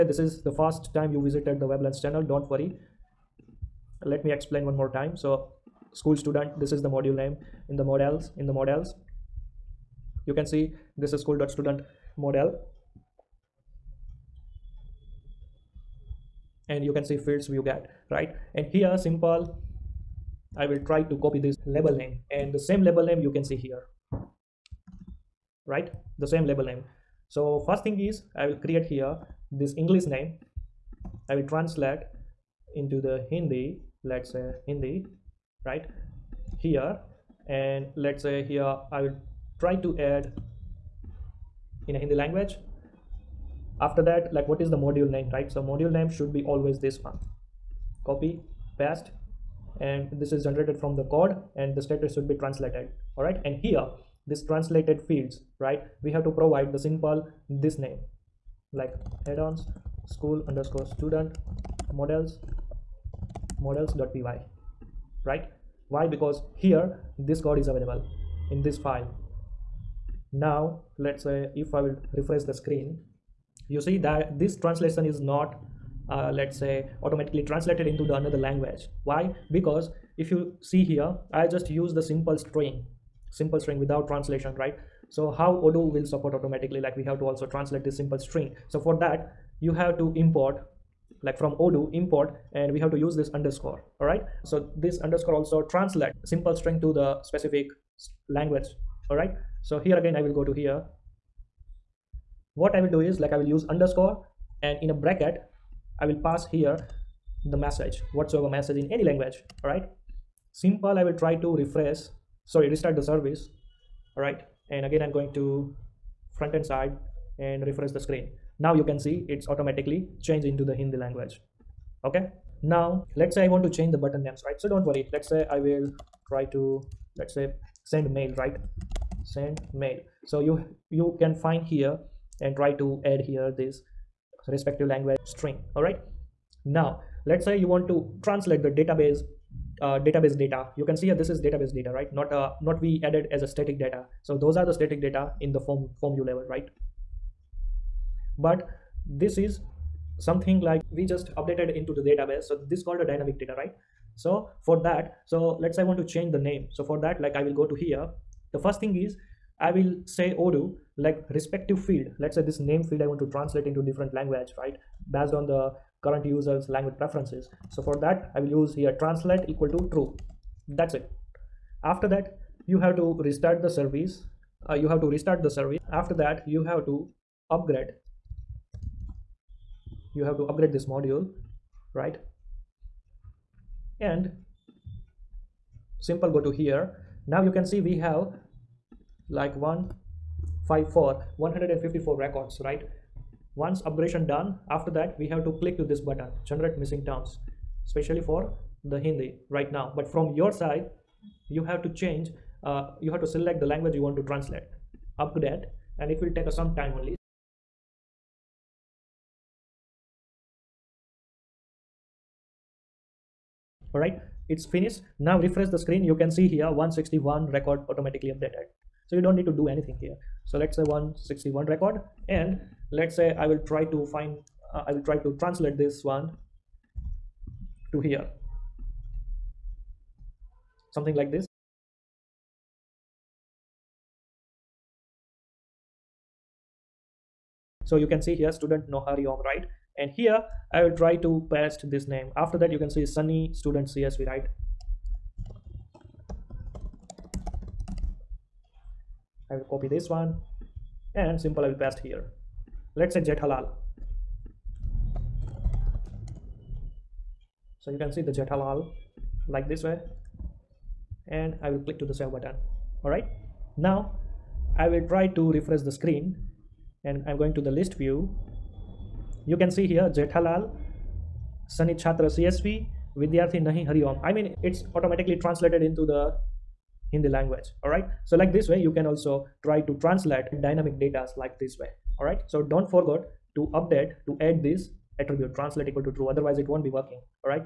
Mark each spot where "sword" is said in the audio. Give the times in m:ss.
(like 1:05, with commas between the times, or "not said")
not said.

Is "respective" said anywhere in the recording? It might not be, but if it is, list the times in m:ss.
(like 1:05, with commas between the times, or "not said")
2:14, 2:41.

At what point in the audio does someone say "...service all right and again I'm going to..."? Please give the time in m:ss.
1:53.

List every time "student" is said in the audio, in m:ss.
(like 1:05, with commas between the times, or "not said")
0:06, 0:11, 1:00, 3:58, 4:03.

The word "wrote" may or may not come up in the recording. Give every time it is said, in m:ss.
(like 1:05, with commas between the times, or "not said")
not said.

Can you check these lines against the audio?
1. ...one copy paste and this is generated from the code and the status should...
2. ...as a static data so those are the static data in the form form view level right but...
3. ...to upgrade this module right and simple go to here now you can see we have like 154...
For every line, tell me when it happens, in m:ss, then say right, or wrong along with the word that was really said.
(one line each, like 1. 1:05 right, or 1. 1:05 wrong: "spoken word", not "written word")
1. 0:47 right
2. 2:23 right
3. 3:00 right.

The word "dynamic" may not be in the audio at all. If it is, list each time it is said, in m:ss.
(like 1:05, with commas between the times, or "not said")
2:33, 4:40.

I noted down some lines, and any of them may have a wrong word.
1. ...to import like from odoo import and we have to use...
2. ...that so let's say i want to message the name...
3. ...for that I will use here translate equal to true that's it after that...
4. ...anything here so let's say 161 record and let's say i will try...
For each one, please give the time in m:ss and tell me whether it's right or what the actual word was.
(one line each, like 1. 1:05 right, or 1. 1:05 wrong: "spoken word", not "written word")
1. 1:29 right
2. 2:34 wrong: "change", not "message"
3. 2:47 right
4. 3:39 right.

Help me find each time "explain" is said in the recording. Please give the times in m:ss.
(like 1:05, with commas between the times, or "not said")
0:04.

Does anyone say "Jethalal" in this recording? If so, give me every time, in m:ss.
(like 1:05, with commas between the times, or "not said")
4:13, 4:18, 4:30.